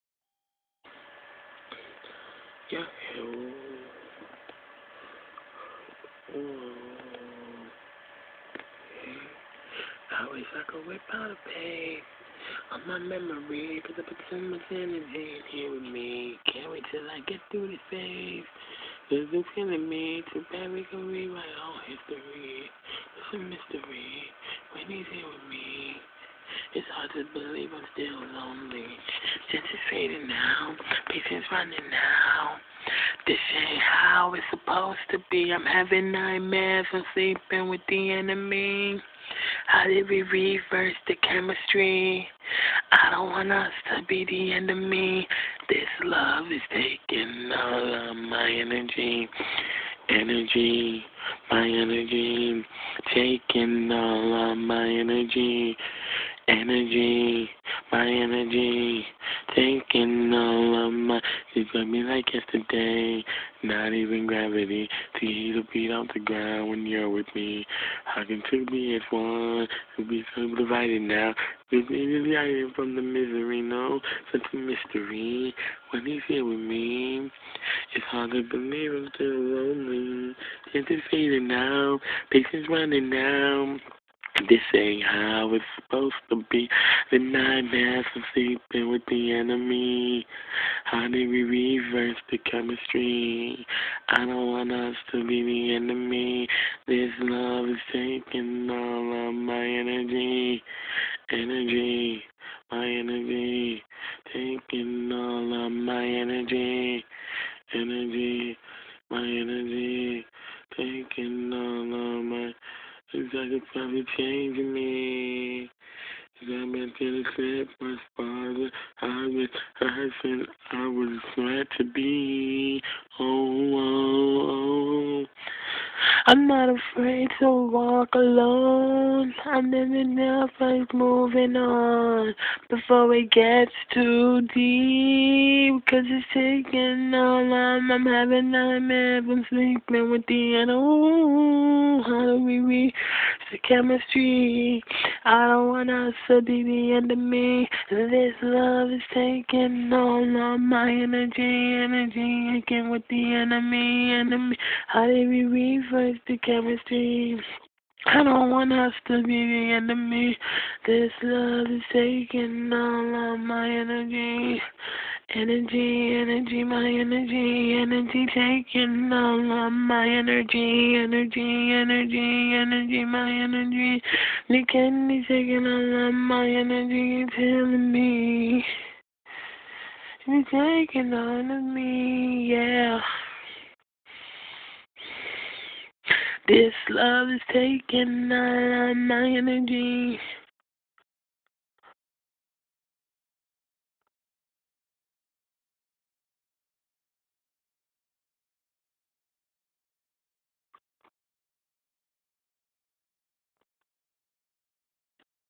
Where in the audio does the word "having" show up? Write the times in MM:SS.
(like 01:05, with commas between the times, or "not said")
00:35, 02:18.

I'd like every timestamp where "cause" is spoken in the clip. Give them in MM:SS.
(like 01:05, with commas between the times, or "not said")
00:13, 02:15.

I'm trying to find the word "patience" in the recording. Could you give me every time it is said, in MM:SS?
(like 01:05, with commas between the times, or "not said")
00:31, 01:22.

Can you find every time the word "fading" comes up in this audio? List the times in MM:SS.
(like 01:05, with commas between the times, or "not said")
00:29, 01:21.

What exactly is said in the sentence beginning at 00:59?
Thinking all of my, she's me like yesterday.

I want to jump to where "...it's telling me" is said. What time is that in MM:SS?
02:57.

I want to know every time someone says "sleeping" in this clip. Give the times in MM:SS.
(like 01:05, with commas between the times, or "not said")
00:37, 01:28, 02:19.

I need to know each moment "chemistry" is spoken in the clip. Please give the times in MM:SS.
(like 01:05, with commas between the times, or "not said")
00:41, 01:32, 02:23, 02:36.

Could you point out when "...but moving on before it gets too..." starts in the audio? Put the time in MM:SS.
02:10.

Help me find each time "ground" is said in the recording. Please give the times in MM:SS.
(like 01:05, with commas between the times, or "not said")
01:06.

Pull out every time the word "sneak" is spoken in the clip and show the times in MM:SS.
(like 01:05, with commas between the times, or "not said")
not said.